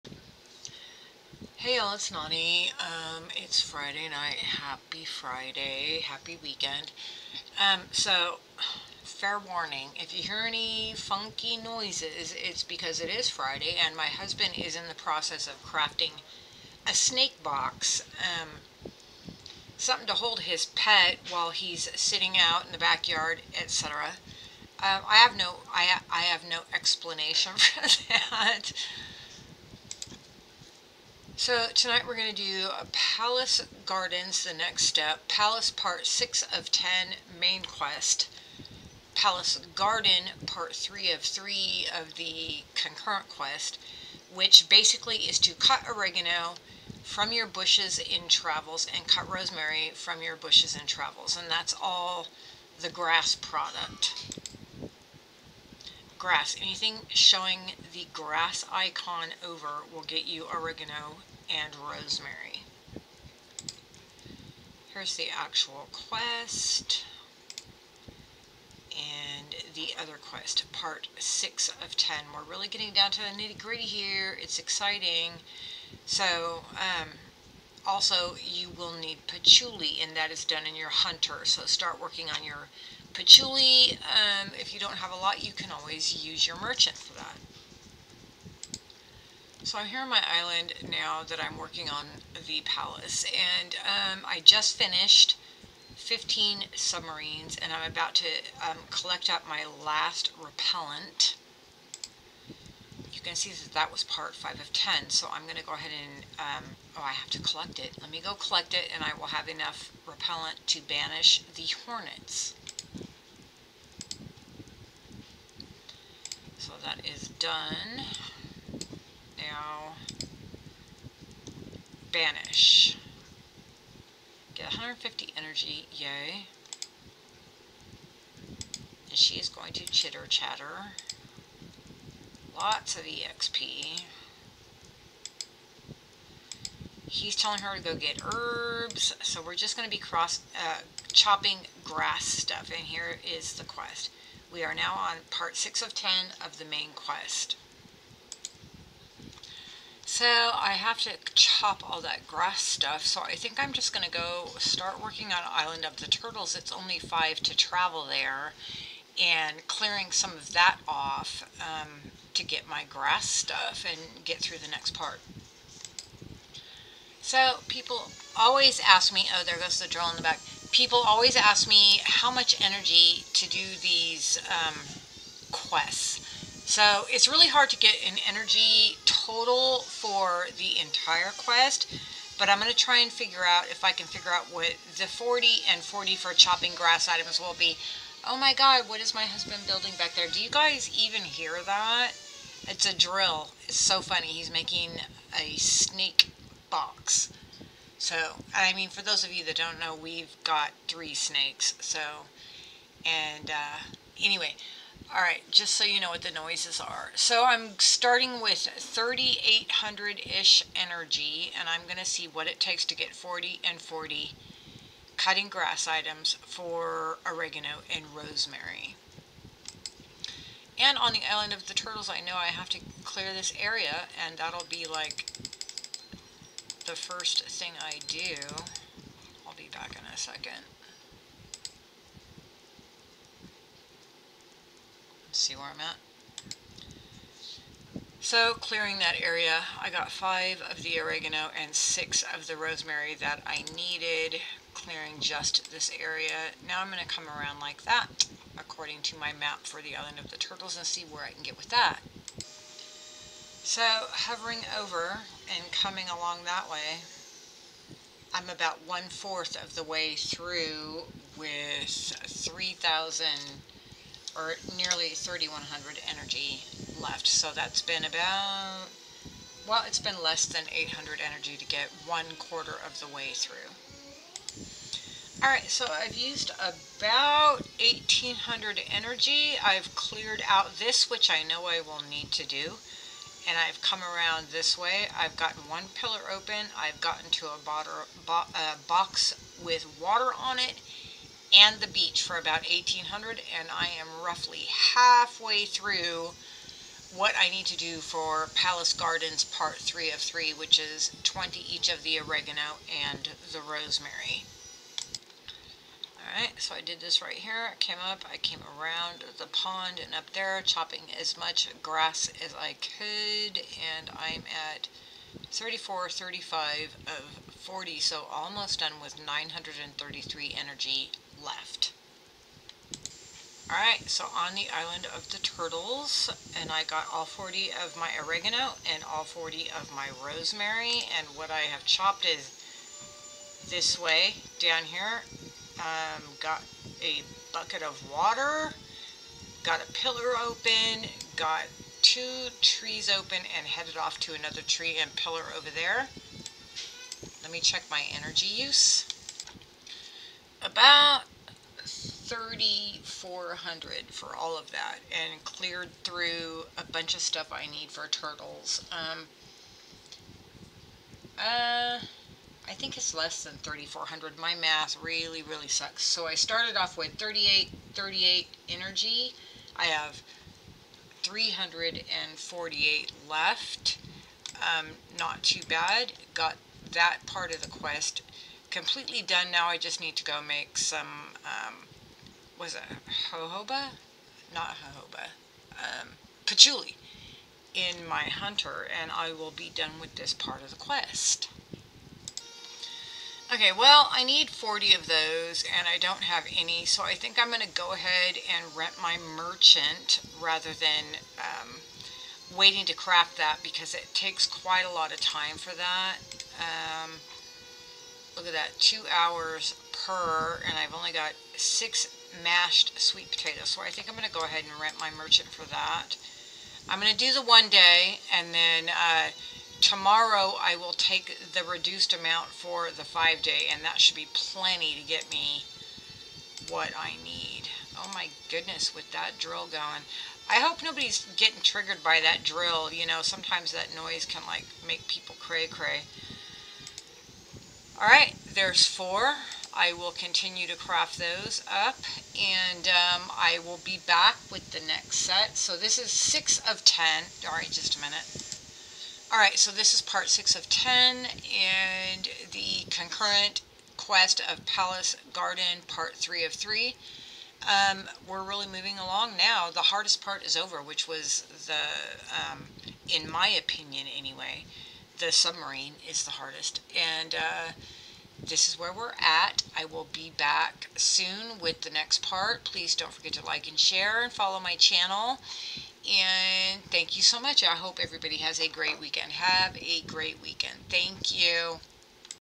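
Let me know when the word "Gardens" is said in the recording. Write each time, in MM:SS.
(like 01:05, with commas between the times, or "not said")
00:33, 00:39, 04:58, 07:35.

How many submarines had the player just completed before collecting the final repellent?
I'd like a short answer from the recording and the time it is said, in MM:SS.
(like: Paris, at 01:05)
15, at 01:35.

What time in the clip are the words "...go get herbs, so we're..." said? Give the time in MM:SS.
02:17.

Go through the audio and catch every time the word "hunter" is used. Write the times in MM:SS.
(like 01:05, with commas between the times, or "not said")
01:20, 06:28.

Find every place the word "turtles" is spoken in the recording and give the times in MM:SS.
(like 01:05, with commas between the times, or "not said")
02:36, 03:41, 04:10, 05:25, 05:58.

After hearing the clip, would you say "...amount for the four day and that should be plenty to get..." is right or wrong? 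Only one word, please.
wrong.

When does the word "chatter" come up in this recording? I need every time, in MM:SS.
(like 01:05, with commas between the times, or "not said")
02:10.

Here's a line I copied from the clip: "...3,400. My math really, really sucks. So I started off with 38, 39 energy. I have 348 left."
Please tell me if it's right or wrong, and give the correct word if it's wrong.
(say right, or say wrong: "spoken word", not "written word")
wrong: "38", not "39".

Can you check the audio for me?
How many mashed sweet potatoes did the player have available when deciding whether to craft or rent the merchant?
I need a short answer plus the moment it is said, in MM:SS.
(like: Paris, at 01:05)
6, at 06:51.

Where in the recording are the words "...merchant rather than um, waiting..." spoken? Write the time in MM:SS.
06:39.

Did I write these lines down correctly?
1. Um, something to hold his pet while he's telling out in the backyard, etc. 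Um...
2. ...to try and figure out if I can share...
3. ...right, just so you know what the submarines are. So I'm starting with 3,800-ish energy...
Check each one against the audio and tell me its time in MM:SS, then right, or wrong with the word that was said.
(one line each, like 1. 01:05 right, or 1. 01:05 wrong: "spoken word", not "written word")
1. 00:18 wrong: "sitting", not "telling"
2. 03:02 wrong: "figure", not "share"
3. 03:25 wrong: "noises", not "submarines".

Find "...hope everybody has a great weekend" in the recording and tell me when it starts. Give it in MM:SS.
07:57.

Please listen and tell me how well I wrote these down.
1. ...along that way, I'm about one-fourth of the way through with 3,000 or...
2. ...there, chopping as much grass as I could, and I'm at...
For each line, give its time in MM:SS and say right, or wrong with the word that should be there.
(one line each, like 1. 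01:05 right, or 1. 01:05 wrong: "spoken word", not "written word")
1. 04:16 right
2. 05:10 right.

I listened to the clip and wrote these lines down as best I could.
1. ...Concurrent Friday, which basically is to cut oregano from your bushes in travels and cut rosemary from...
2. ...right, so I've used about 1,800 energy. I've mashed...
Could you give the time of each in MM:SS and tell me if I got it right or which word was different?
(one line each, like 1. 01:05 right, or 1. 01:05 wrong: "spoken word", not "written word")
1. 00:42 wrong: "Quest", not "Friday"
2. 04:35 wrong: "cleared", not "mashed".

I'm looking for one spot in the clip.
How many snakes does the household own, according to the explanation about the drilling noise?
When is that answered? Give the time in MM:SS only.
03:20.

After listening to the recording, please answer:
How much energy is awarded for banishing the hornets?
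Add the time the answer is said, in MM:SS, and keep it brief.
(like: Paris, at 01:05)
150, at 02:04.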